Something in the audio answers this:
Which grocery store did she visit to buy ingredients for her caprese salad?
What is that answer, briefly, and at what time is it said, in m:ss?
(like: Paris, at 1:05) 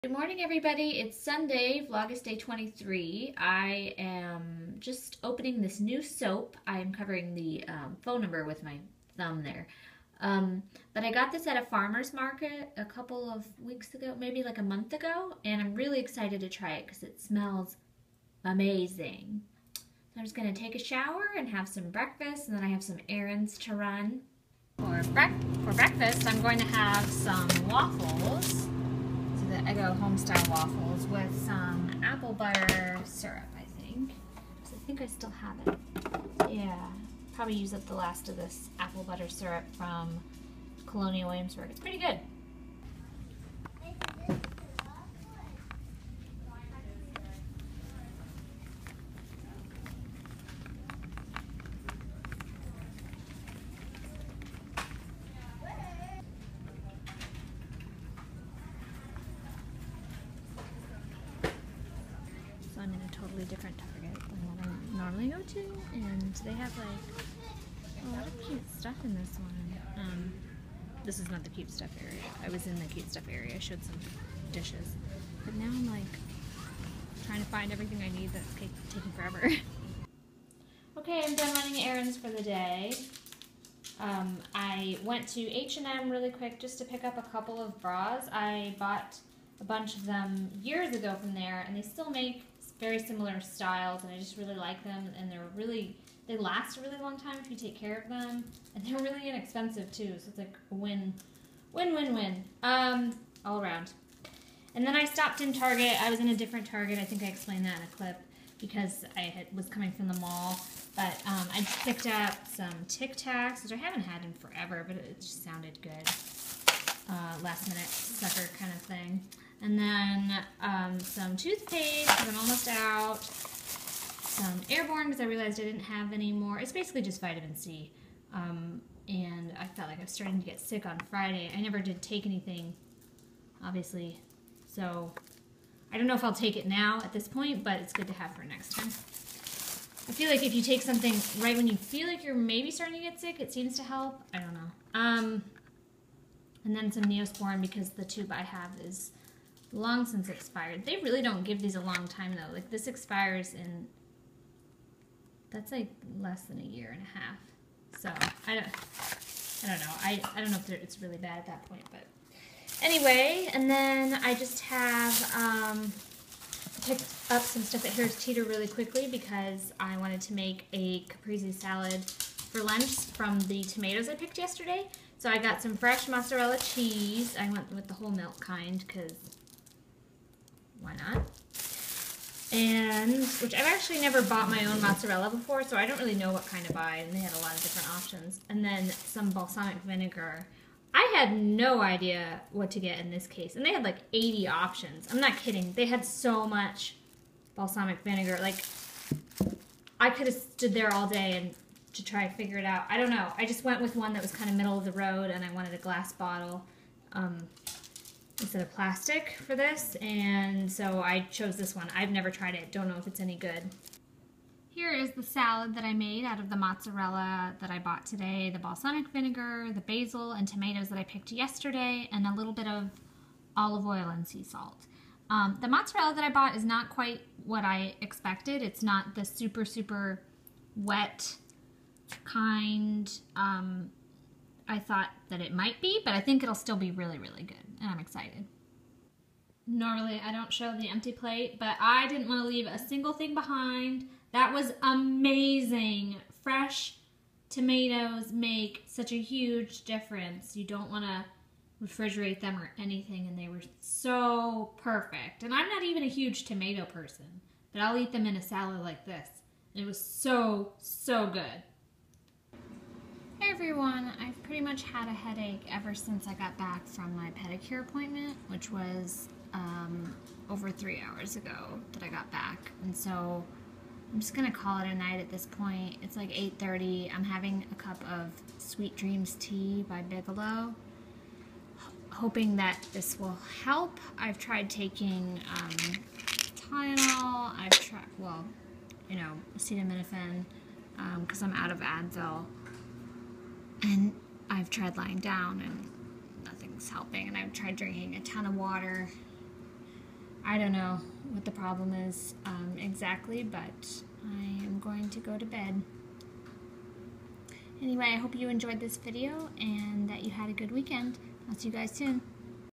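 Harris Teeter, at 2:47.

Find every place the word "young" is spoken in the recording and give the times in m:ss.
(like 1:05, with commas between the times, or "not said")
not said.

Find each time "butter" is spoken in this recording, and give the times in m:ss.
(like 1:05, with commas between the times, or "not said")
0:32, 0:39.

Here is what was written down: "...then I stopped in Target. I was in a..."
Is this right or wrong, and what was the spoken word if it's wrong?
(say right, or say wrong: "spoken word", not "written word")
right.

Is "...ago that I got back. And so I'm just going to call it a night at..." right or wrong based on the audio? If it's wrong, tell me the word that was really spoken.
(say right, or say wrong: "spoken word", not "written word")
right.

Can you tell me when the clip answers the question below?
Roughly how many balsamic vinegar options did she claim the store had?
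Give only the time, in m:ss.
3:14.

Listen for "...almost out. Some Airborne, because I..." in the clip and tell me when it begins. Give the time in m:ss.
2:02.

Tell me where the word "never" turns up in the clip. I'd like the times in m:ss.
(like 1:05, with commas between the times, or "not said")
2:11, 3:04, 3:32.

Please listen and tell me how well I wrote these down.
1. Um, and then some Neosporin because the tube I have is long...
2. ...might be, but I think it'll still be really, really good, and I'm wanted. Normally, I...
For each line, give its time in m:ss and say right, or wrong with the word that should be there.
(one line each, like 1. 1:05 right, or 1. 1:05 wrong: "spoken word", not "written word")
1. 2:24 right
2. 3:55 wrong: "excited", not "wanted".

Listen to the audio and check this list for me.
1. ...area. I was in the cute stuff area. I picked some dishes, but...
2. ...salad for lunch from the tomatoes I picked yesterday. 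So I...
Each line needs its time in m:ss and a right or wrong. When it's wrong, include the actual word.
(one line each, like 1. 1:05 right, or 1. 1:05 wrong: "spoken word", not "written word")
1. 1:12 wrong: "showed", not "picked"
2. 2:51 right.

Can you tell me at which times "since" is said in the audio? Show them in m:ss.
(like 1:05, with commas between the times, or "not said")
2:30, 4:25.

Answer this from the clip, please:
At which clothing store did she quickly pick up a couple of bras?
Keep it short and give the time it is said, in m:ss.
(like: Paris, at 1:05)
H&M, at 1:25.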